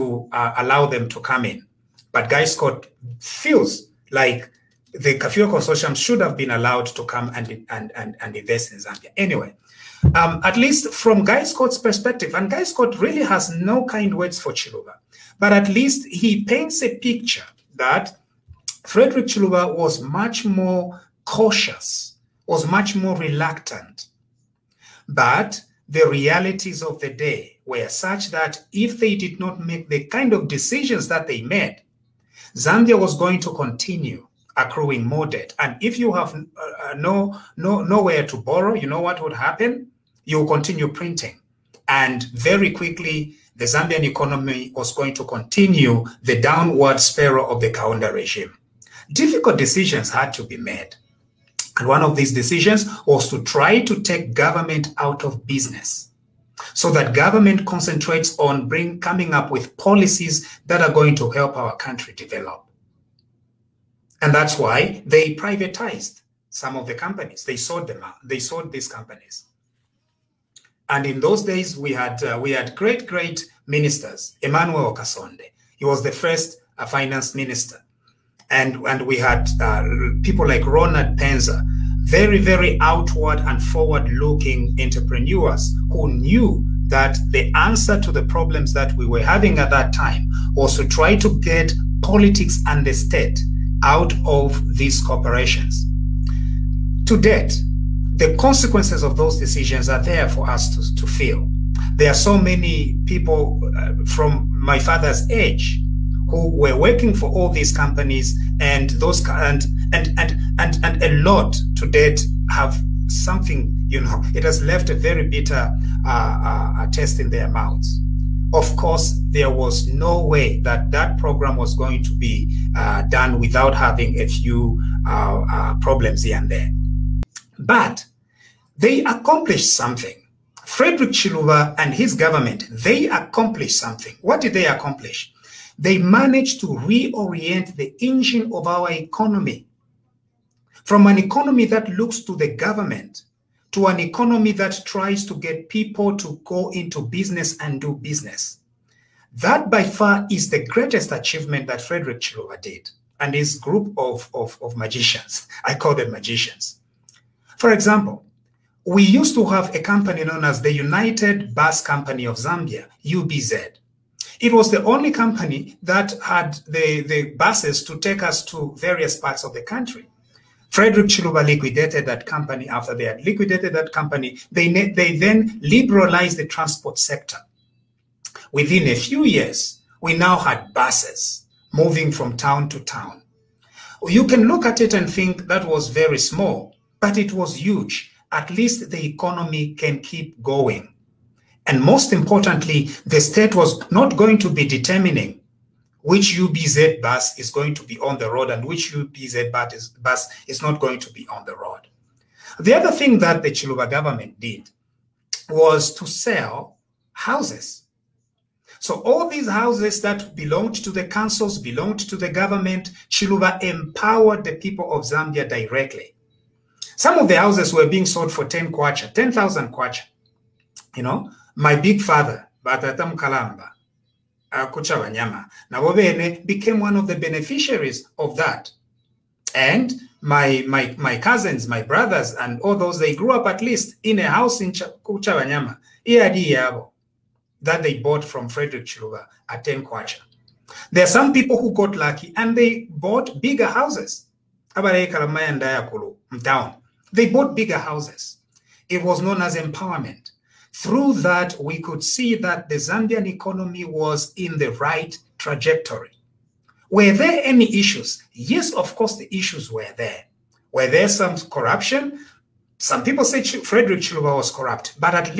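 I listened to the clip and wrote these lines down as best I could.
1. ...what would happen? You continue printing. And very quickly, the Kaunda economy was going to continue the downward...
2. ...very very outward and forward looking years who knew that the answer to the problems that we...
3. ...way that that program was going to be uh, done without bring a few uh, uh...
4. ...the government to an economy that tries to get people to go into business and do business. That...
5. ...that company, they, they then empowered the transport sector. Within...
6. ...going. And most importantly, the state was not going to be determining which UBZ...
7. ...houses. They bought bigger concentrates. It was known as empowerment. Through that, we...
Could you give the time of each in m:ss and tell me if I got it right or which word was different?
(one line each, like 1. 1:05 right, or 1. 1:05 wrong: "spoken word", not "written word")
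1. 0:38 wrong: "Zambian", not "Kaunda"
2. 1:22 wrong: "entrepreneurs", not "years"
3. 2:00 wrong: "having", not "bring"
4. 2:22 right
5. 2:53 wrong: "liberalized", not "empowered"
6. 3:10 right
7. 4:03 wrong: "houses", not "concentrates".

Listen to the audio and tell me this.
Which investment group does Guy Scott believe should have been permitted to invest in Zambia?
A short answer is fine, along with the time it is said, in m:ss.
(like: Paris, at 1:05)
Kafue Consortium, at 0:05.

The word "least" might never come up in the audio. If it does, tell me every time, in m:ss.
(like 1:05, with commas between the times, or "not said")
0:10, 0:15, 3:08, 3:53.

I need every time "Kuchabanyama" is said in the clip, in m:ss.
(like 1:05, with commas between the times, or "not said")
3:55.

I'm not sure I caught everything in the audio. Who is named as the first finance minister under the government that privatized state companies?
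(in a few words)
Emmanuel Okasonde.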